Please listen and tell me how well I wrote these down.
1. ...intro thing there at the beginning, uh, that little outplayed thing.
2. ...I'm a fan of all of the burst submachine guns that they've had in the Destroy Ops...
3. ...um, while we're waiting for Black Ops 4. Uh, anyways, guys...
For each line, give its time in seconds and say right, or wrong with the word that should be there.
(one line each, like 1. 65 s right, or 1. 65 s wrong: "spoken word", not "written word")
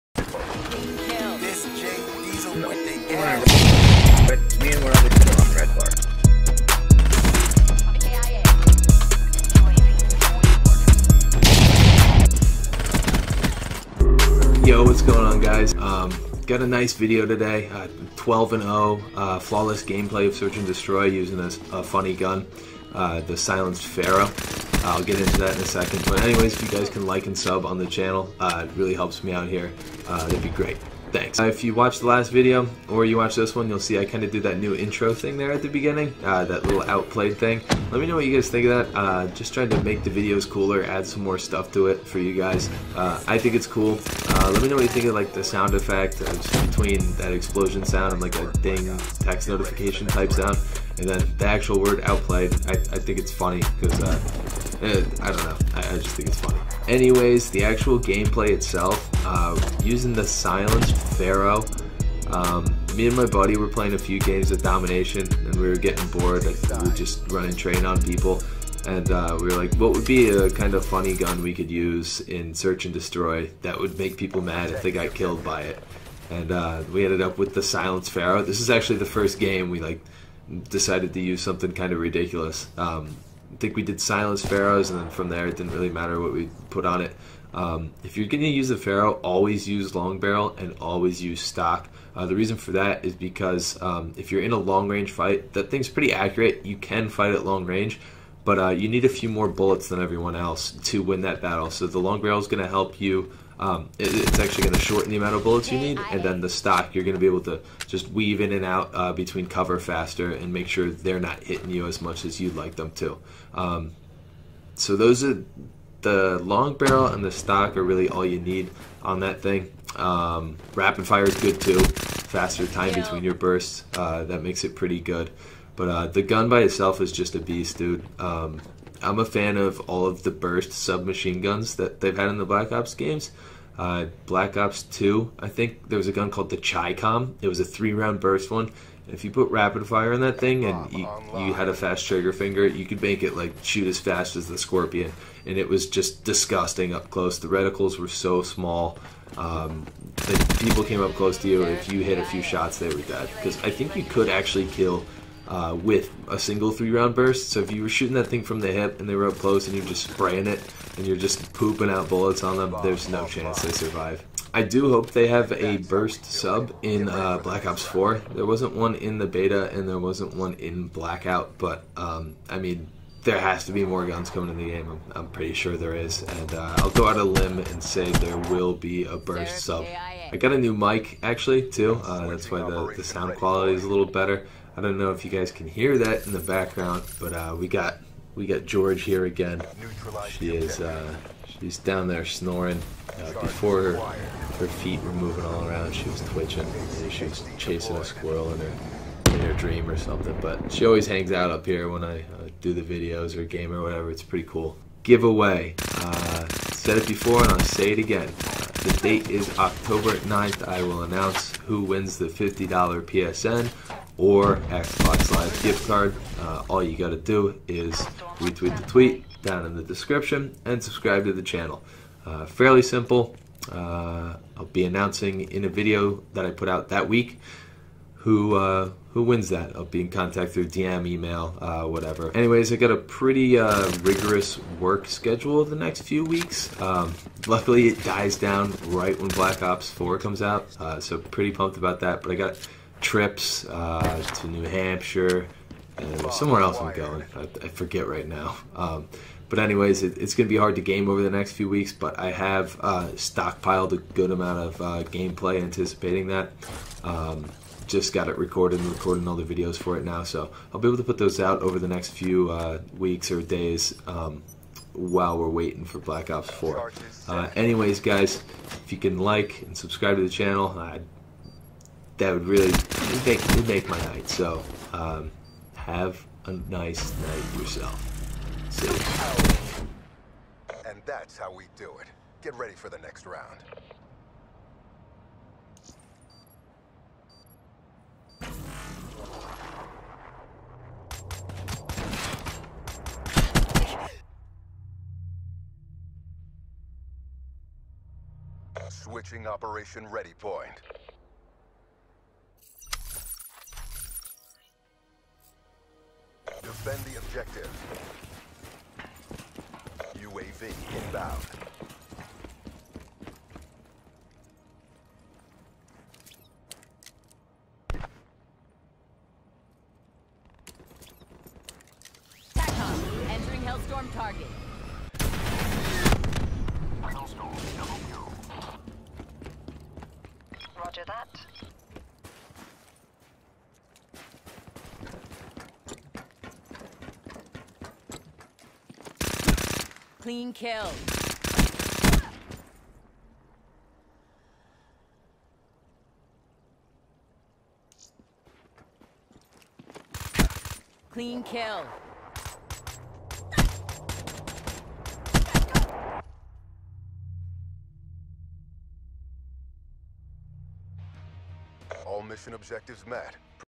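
1. 34 s right
2. 129 s wrong: "Black", not "Destroy"
3. 264 s right.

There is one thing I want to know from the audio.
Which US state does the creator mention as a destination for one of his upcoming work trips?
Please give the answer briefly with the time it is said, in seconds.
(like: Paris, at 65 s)
New Hampshire, at 244 s.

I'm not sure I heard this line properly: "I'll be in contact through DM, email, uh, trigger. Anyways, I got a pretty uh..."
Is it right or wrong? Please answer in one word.
wrong.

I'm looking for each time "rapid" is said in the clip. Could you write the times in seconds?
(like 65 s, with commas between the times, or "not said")
120 s, 139 s.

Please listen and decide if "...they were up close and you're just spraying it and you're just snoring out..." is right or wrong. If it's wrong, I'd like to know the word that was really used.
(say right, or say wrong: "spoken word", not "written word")
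wrong: "pooping", not "snoring".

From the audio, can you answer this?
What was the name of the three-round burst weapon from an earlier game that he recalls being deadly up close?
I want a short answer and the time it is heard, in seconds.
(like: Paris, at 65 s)
Chicom, at 136 s.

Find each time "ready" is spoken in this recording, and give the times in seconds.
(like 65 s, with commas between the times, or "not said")
282 s, 300 s.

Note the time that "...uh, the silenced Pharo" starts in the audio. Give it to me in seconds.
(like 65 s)
22 s.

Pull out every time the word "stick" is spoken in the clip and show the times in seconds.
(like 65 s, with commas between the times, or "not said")
not said.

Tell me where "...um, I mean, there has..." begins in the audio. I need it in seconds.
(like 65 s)
171 s.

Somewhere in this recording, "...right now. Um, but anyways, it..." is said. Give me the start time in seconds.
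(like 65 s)
248 s.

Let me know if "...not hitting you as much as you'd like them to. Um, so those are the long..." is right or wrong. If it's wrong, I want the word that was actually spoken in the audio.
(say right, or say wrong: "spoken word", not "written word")
right.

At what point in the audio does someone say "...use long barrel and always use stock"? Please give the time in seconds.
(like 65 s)
89 s.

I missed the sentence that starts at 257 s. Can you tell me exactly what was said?
Um, just got it recorded and recording all the videos for it now.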